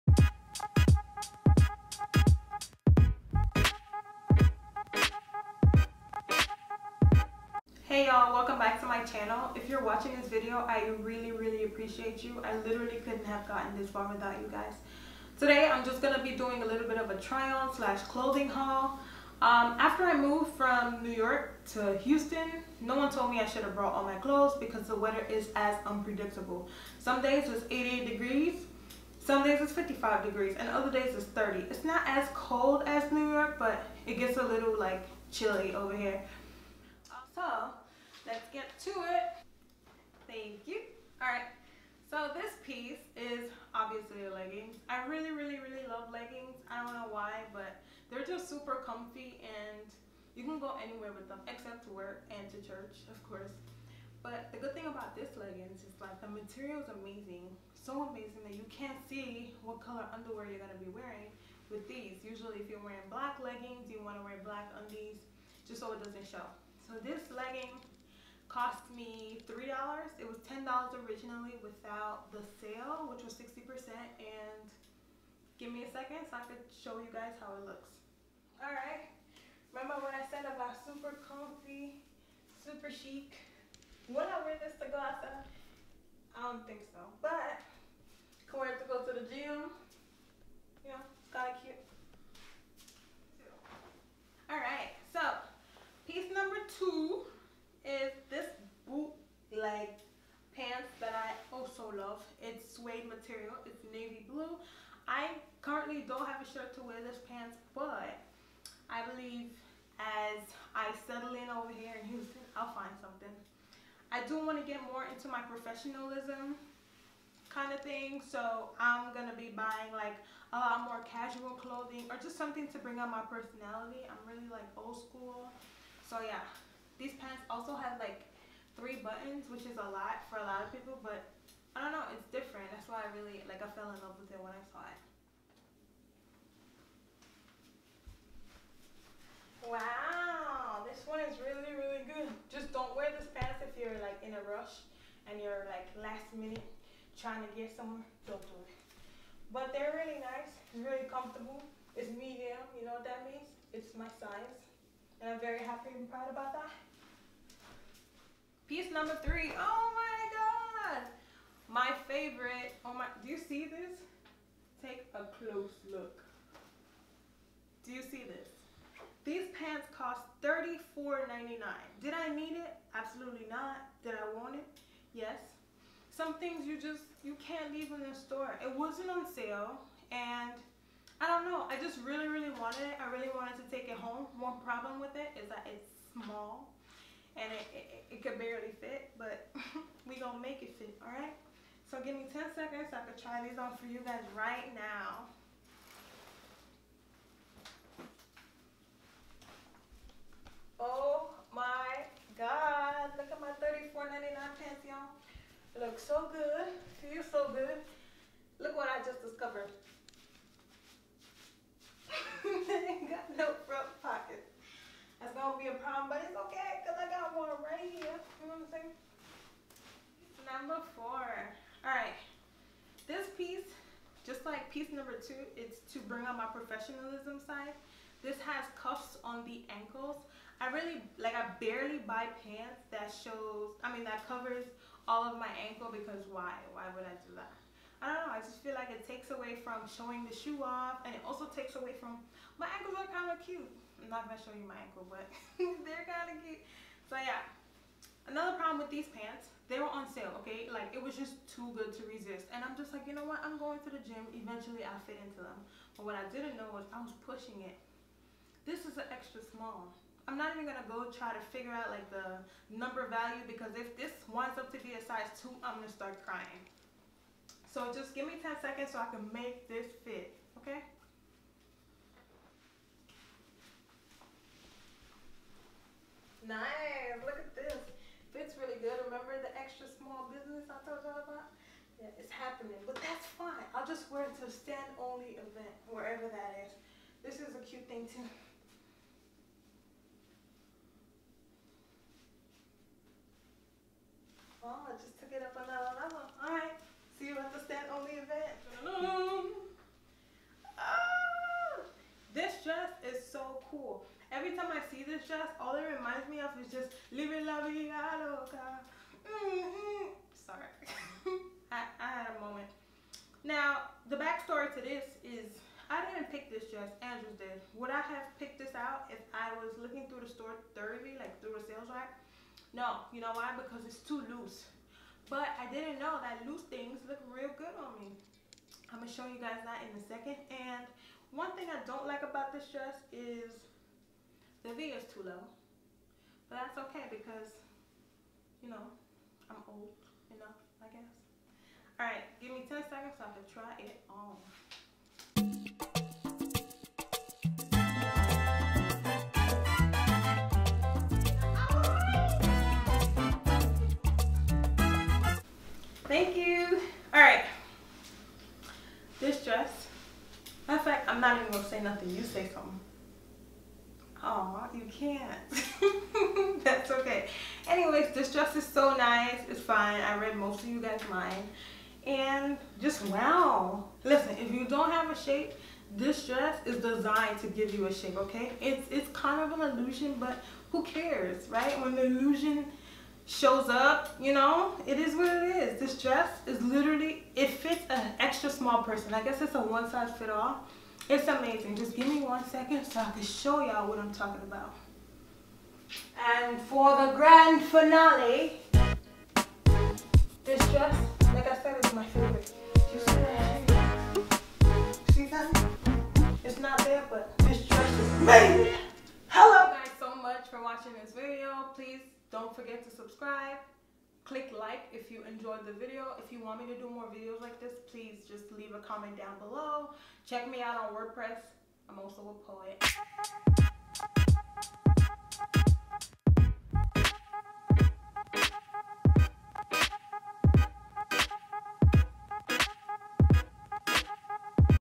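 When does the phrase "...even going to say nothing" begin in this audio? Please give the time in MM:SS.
06:01.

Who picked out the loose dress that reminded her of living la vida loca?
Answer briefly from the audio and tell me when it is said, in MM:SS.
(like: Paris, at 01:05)
Andrews, at 05:17.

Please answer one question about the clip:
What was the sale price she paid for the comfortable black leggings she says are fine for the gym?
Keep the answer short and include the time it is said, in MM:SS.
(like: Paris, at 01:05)
$3, at 01:09.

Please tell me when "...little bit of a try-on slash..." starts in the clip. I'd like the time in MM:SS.
00:16.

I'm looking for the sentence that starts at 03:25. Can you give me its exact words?
Looks so good, feels so good.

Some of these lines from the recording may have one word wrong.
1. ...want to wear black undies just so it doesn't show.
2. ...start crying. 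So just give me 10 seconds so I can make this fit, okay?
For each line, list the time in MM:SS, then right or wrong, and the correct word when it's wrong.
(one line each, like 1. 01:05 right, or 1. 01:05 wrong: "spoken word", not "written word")
1. 01:03 right
2. 04:25 right.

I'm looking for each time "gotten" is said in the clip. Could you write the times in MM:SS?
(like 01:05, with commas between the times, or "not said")
00:13.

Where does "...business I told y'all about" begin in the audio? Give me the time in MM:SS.
04:40.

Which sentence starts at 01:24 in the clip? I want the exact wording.
Would I wear this to go I don't think so, but can wear it to go to the gym.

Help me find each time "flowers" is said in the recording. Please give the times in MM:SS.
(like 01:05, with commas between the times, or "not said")
not said.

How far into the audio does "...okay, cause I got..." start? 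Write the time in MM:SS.
03:36.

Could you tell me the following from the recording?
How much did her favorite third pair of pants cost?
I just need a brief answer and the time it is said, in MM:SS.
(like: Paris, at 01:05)
$34.99, at 02:50.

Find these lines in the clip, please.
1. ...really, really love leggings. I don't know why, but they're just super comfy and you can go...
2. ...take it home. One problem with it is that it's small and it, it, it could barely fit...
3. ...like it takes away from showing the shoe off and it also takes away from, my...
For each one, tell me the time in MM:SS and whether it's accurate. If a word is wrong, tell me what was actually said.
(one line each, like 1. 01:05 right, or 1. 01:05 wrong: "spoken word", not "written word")
1. 00:45 right
2. 03:03 right
3. 03:58 right.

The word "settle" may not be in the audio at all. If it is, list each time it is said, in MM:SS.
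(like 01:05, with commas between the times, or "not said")
01:51.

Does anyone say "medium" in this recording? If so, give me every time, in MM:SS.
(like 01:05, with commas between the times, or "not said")
02:32.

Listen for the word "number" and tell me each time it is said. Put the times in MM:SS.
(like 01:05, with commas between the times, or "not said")
02:38, 03:40, 03:44, 04:22.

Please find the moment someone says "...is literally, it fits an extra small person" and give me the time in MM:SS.
06:26.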